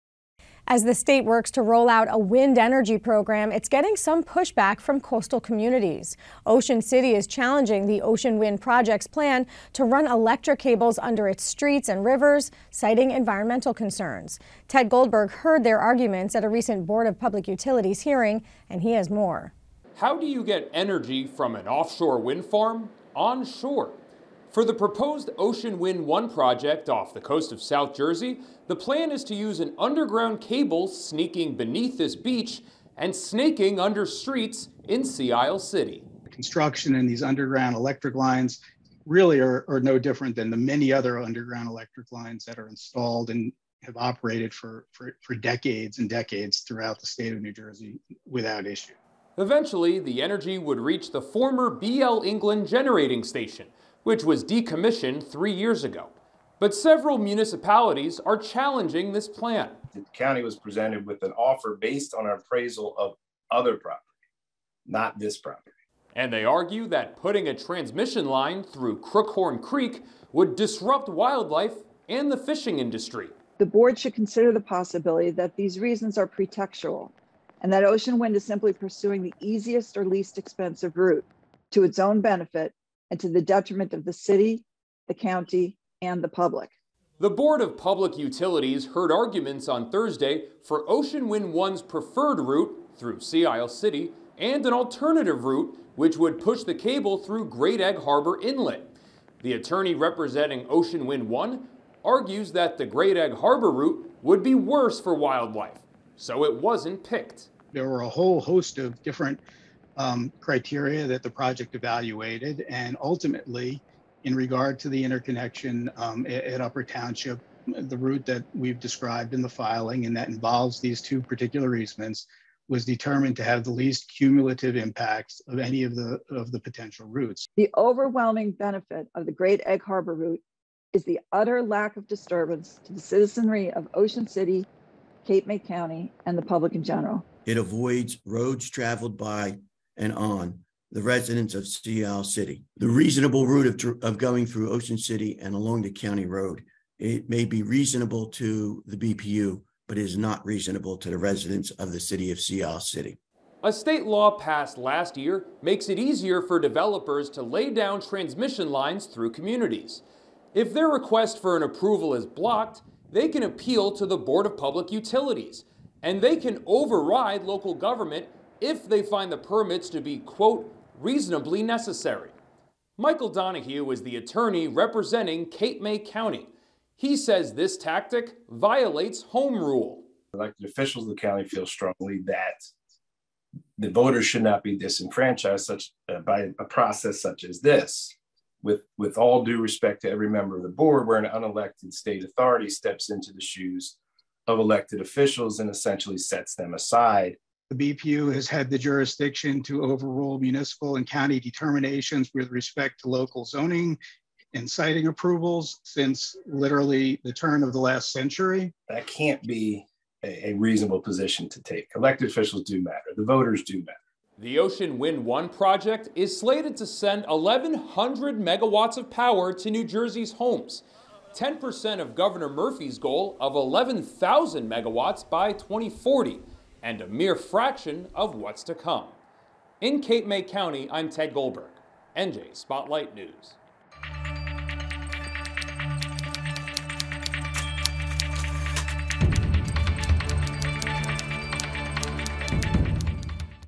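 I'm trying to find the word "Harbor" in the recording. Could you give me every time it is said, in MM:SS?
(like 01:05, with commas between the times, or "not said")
01:37, 01:43, 02:09.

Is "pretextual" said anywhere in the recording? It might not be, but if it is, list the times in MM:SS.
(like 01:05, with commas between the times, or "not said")
01:16.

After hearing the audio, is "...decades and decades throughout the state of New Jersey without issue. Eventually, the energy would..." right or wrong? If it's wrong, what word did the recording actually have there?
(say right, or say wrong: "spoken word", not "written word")
right.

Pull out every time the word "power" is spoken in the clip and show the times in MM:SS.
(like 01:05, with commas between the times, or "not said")
03:39.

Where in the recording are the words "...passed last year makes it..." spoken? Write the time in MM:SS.
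02:34.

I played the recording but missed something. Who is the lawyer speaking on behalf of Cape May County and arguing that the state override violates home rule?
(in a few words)
Michael Donahue.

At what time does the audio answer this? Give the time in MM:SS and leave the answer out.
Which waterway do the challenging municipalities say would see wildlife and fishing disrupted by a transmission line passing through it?
01:09.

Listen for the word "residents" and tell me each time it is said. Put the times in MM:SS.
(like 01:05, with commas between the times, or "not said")
02:21, 02:31.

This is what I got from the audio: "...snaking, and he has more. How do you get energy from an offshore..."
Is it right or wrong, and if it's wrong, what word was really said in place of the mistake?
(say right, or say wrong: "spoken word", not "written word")
wrong: "hearing", not "snaking".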